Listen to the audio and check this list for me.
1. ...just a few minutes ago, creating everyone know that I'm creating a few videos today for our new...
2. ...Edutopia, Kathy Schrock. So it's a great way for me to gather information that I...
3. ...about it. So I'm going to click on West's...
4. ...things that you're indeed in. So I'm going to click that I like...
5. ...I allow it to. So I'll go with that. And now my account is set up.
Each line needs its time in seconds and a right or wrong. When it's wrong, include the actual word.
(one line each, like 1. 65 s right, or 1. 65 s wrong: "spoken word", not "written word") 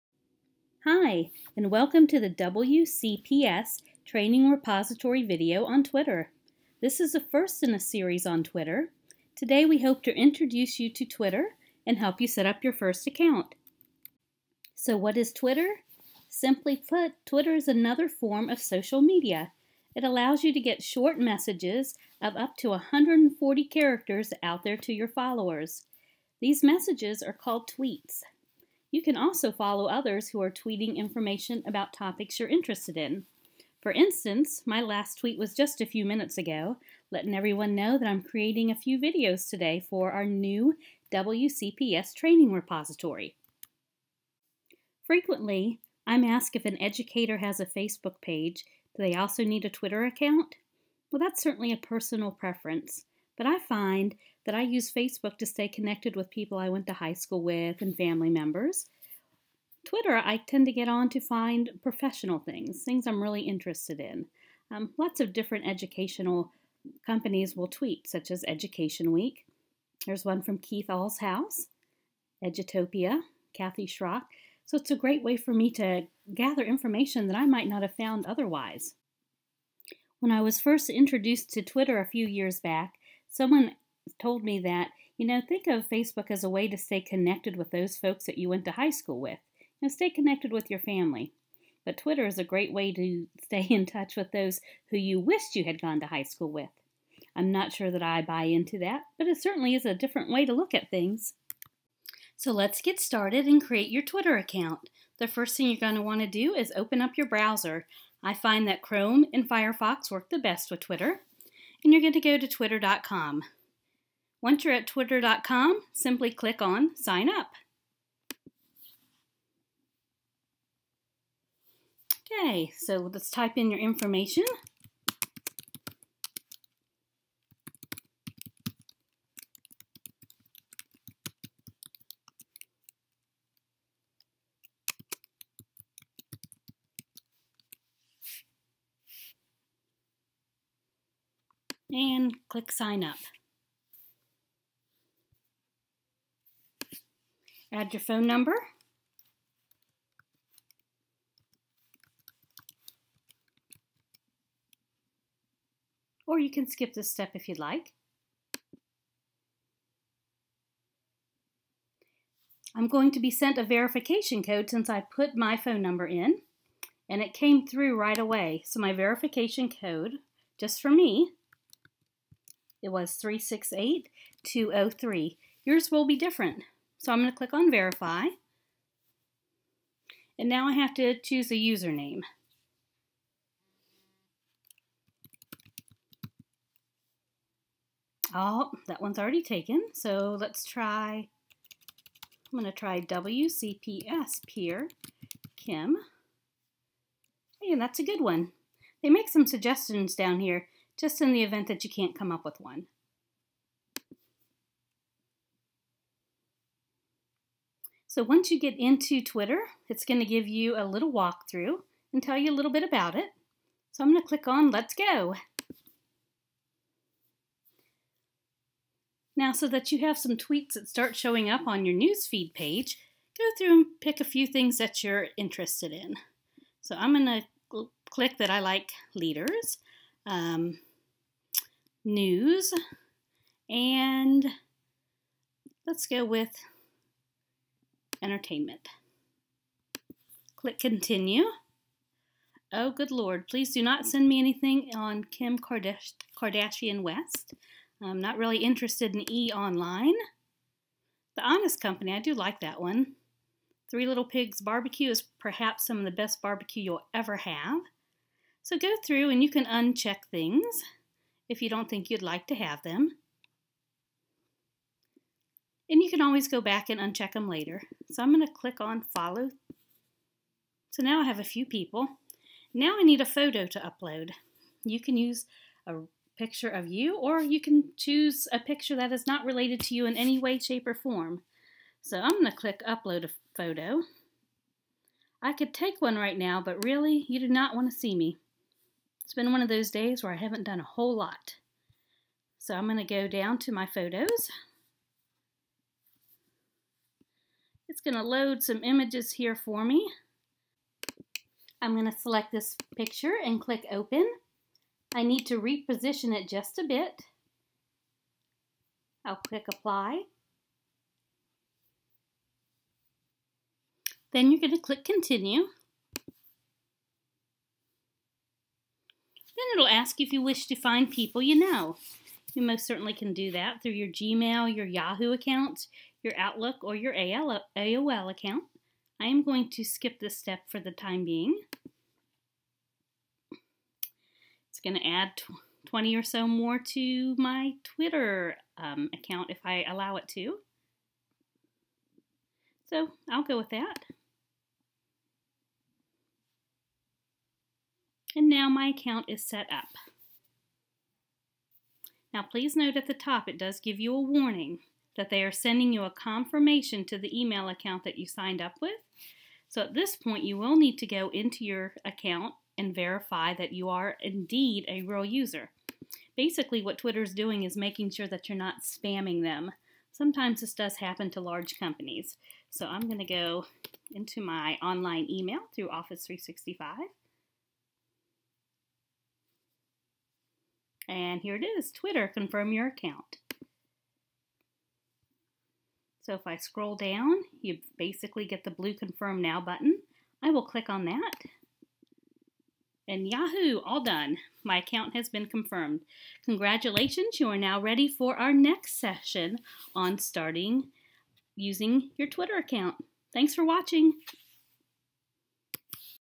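1. 35 s wrong: "letting", not "creating"
2. 72 s right
3. 212 s wrong: "Let", not "West"
4. 224 s wrong: "interested", not "indeed"
5. 339 s right.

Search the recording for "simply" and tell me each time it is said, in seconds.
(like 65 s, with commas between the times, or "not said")
16 s, 115 s.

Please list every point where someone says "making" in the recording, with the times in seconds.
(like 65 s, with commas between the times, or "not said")
367 s.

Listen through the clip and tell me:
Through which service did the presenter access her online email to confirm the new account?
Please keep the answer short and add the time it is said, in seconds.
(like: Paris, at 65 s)
Office 365, at 375 s.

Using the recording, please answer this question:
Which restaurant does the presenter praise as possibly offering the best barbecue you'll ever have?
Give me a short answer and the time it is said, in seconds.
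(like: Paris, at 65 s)
Three Little Pigs Barbecue, at 253 s.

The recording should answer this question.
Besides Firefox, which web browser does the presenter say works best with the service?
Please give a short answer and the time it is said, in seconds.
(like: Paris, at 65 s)
Chrome, at 108 s.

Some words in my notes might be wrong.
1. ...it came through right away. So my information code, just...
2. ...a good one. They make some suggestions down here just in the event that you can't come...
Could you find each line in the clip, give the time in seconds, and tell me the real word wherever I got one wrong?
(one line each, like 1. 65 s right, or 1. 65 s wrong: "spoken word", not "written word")
1. 167 s wrong: "verification", not "information"
2. 197 s right.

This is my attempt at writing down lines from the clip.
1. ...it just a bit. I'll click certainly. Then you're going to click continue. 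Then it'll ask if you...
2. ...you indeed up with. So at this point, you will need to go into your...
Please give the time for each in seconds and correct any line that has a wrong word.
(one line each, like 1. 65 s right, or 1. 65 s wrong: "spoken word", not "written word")
1. 306 s wrong: "apply", not "certainly"
2. 358 s wrong: "signed", not "indeed".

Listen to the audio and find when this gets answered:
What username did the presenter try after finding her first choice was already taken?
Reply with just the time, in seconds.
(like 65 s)
193 s.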